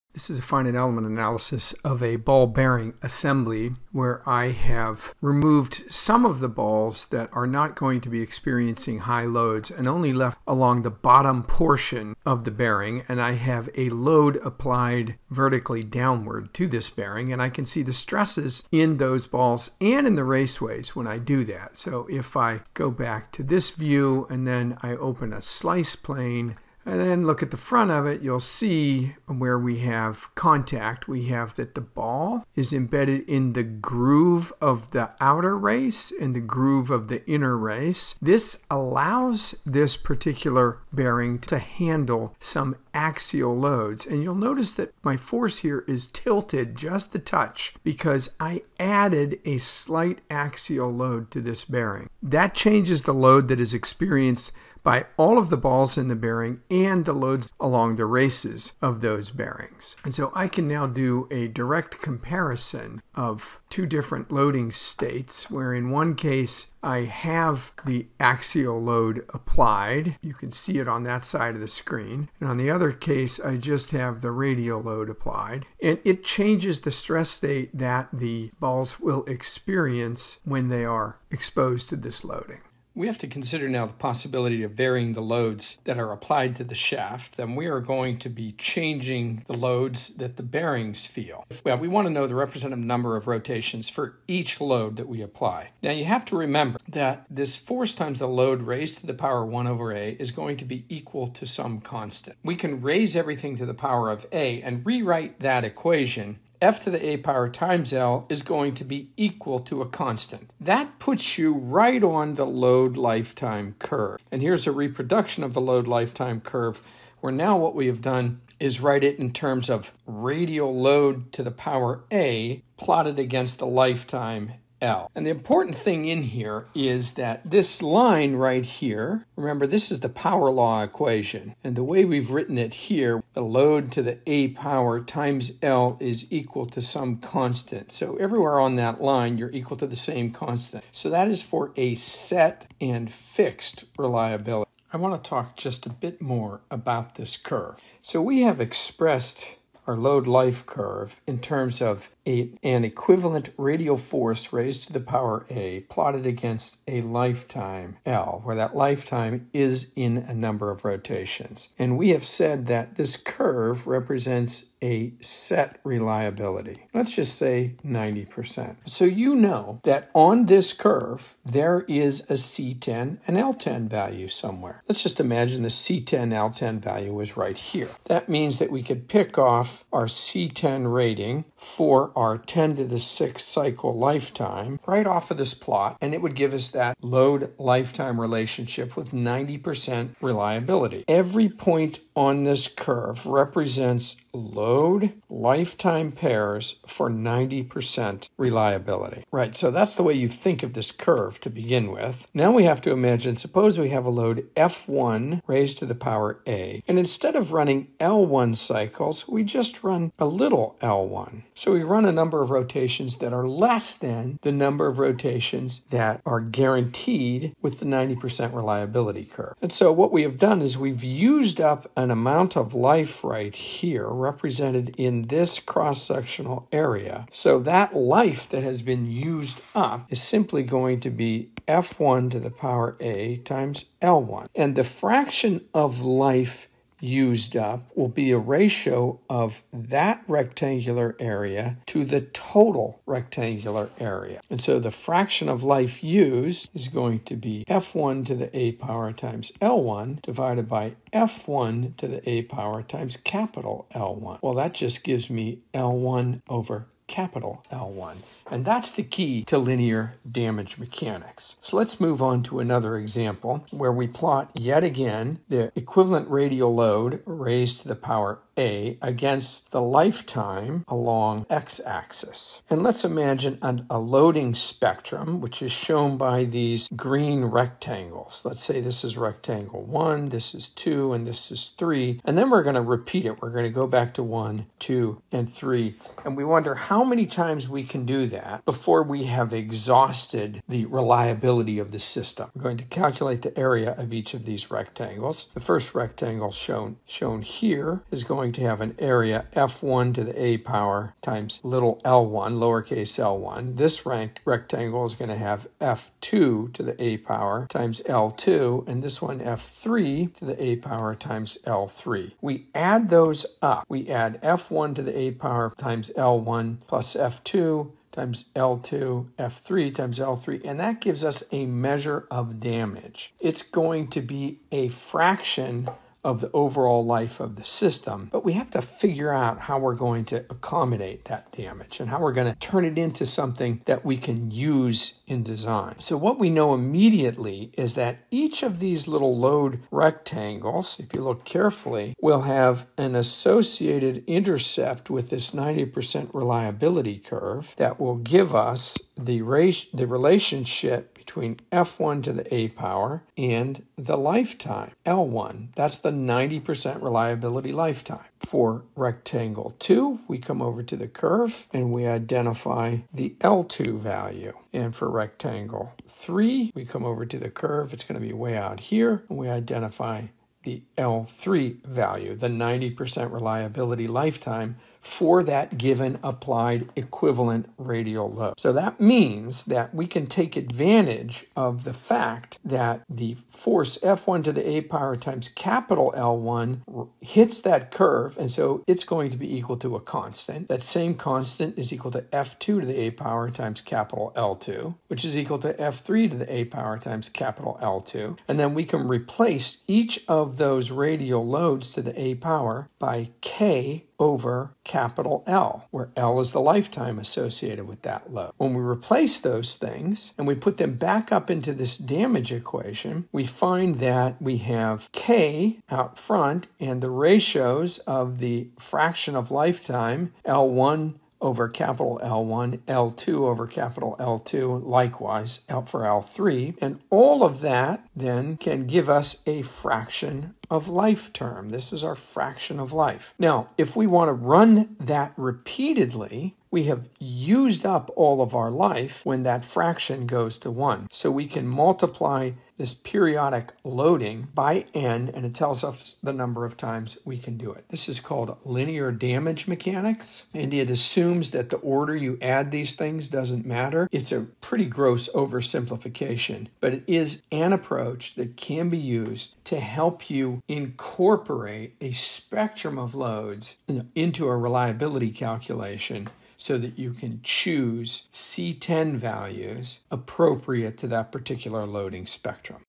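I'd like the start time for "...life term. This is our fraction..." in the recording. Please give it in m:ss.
7:10.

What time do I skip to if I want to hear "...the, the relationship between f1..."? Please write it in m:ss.
5:49.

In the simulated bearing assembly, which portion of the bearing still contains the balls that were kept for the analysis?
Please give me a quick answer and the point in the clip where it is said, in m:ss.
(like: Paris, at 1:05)
bottom portion, at 0:10.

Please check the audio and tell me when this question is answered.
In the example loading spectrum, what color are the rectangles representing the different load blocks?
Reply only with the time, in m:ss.
4:36.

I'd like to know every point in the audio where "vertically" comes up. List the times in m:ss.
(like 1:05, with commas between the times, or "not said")
0:15.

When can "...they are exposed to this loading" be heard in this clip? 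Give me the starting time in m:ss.
1:20.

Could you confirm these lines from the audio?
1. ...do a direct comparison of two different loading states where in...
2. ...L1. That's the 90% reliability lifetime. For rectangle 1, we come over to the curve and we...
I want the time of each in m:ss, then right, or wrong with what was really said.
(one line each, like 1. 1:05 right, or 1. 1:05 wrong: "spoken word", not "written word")
1. 1:00 right
2. 5:55 wrong: "2", not "1".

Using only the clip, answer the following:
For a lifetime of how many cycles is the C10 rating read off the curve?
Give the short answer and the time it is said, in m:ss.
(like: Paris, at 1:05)
10^6, at 3:02.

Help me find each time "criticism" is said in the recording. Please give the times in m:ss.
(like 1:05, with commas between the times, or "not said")
not said.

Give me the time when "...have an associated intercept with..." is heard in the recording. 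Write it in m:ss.
5:42.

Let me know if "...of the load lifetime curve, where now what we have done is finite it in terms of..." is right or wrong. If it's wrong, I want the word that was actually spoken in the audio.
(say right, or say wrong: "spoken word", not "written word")
wrong: "write", not "finite".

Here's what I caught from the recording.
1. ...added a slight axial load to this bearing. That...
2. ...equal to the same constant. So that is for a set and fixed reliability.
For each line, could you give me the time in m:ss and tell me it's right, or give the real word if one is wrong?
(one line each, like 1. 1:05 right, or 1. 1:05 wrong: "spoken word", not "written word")
1. 0:48 right
2. 2:19 right.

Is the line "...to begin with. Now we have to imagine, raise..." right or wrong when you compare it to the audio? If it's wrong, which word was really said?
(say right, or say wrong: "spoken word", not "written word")
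wrong: "suppose", not "raise".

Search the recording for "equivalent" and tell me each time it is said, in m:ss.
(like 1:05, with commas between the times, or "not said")
2:32, 4:25, 6:16.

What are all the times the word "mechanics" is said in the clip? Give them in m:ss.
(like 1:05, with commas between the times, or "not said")
4:20, 7:29.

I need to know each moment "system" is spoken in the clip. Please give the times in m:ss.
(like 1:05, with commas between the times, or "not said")
4:51, 5:27.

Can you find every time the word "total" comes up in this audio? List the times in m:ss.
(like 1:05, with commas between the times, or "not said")
4:02.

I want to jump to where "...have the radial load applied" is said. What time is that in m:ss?
1:13.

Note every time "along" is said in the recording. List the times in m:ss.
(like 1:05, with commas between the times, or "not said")
0:10, 0:57, 4:30.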